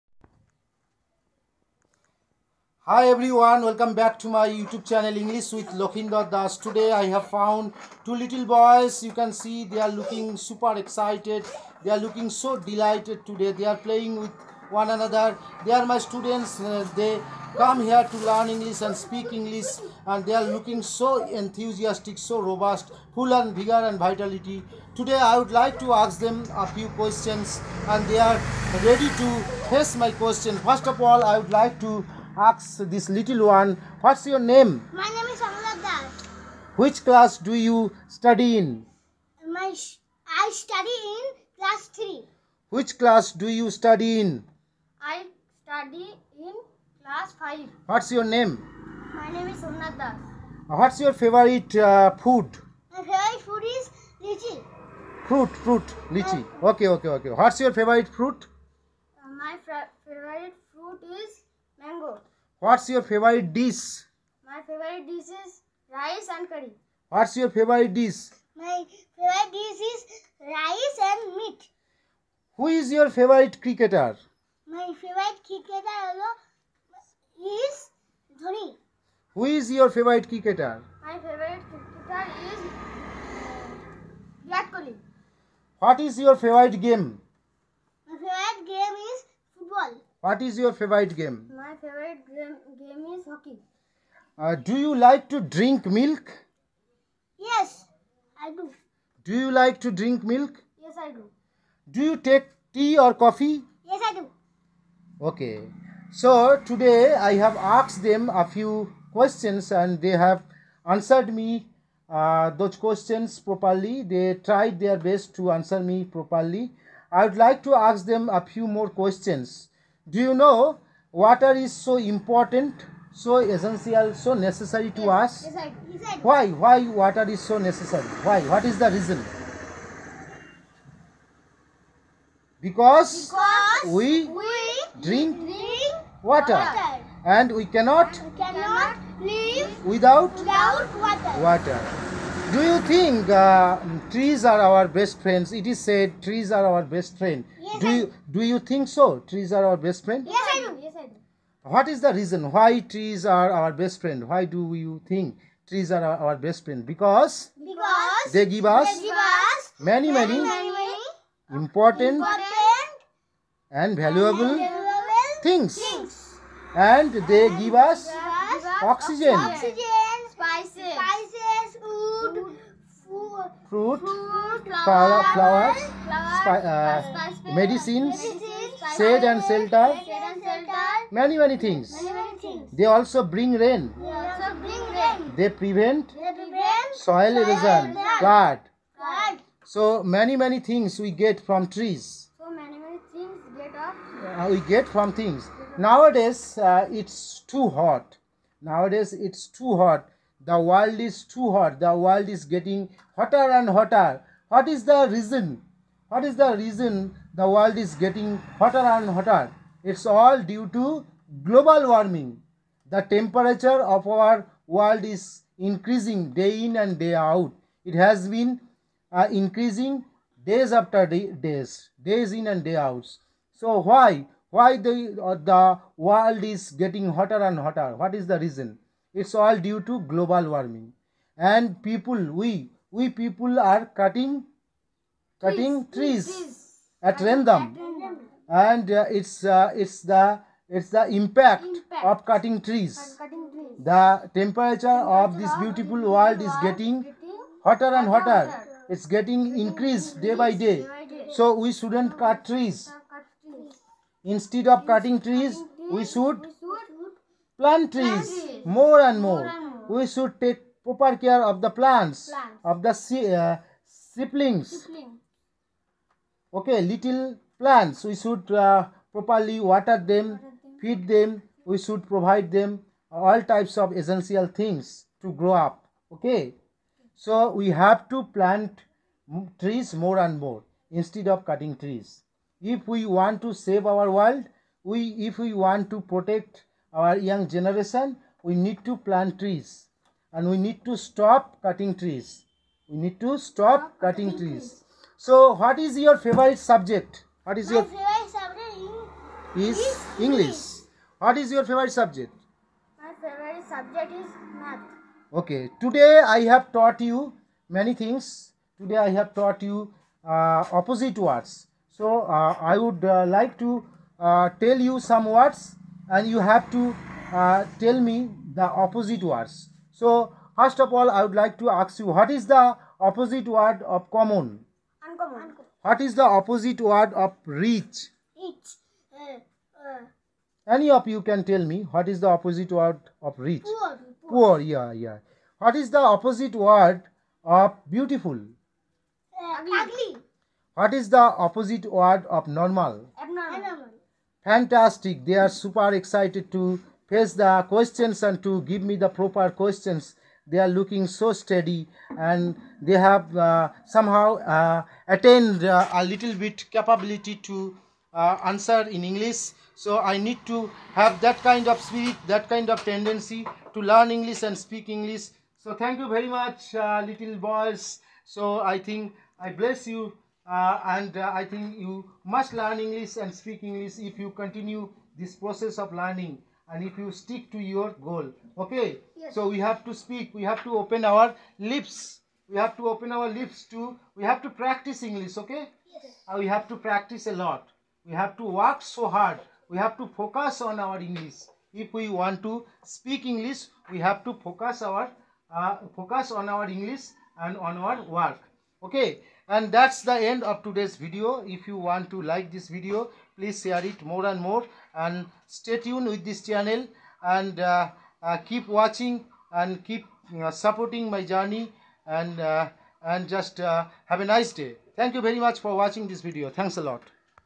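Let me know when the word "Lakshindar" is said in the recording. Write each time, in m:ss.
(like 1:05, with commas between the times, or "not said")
0:05.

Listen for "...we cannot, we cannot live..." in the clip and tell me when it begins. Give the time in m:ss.
2:17.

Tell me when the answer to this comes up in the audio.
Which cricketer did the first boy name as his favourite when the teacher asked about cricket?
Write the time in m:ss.
1:14.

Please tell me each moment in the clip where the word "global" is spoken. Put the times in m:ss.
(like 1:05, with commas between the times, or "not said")
3:31, 3:50.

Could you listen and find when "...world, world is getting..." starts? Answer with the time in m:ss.
4:05.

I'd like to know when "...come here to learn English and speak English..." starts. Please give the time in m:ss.
0:17.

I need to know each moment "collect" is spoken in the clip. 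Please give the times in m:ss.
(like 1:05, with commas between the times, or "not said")
not said.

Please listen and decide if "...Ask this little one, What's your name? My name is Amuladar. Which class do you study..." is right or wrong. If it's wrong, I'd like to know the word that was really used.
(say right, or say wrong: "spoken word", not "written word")
right.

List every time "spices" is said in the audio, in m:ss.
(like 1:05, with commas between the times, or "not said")
2:50.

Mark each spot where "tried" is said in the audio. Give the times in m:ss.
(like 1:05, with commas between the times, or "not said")
1:54.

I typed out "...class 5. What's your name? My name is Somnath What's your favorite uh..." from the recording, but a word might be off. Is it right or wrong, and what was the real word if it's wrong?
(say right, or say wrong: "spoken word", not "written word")
right.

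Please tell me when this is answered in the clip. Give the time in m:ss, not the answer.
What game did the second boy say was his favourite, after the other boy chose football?
1:31.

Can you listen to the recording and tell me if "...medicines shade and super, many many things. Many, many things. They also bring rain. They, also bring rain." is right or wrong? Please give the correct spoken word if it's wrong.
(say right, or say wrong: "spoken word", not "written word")
wrong: "shelter", not "super".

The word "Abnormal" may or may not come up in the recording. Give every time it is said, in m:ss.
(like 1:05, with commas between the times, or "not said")
5:43.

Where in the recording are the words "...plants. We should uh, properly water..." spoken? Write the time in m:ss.
4:27.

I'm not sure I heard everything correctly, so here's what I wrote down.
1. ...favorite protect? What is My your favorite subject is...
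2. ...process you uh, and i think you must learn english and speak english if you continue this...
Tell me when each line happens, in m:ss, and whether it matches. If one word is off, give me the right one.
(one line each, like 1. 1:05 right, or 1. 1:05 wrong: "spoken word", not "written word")
1. 4:56 wrong: "subject", not "protect"
2. 6:09 wrong: "bless", not "process".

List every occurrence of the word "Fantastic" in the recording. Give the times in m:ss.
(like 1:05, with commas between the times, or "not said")
5:44.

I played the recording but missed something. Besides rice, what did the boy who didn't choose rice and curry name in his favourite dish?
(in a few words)
Meat.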